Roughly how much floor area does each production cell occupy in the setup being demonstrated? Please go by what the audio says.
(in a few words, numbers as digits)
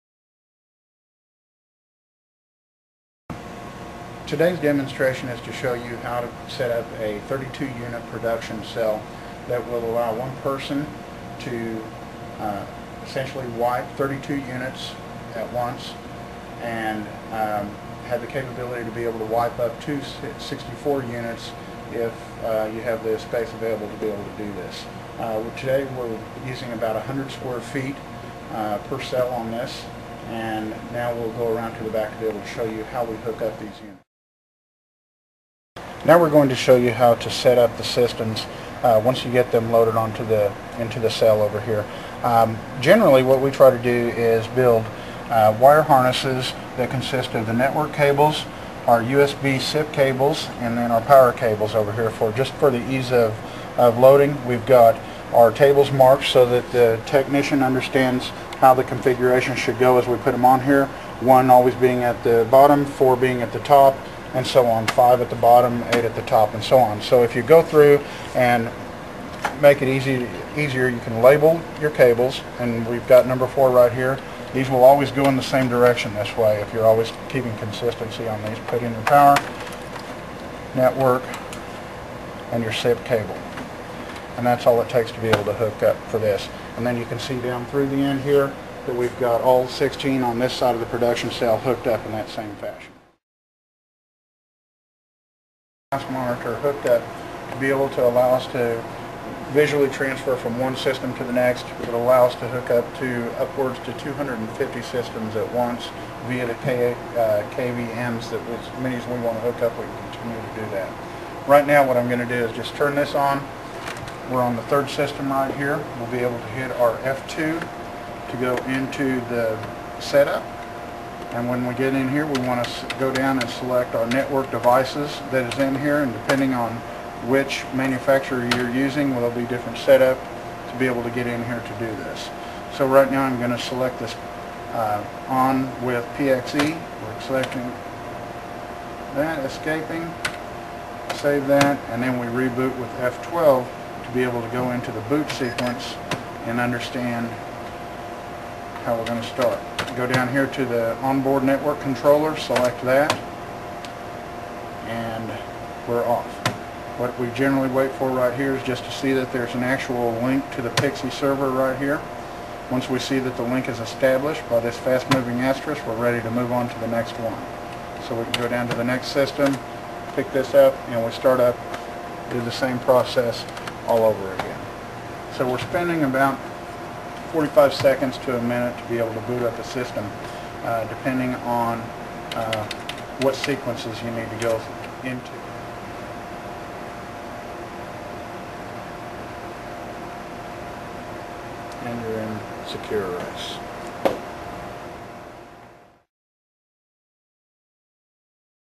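100 square feet.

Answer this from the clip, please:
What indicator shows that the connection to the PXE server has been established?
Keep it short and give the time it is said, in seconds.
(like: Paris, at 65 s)
fast-moving asterisk, at 164 s.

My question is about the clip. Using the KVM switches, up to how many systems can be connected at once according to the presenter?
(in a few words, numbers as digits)
250.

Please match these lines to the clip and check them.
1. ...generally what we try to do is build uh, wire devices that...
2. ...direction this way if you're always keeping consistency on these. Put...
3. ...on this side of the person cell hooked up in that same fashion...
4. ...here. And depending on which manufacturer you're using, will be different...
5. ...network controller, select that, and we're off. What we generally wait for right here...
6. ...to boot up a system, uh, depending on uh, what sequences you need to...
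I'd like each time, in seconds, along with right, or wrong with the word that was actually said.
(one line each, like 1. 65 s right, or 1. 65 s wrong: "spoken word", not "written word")
1. 42 s wrong: "harnesses", not "devices"
2. 75 s right
3. 90 s wrong: "production", not "person"
4. 125 s right
5. 151 s right
6. 179 s right.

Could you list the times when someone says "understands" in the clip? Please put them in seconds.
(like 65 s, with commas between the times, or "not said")
57 s, 146 s.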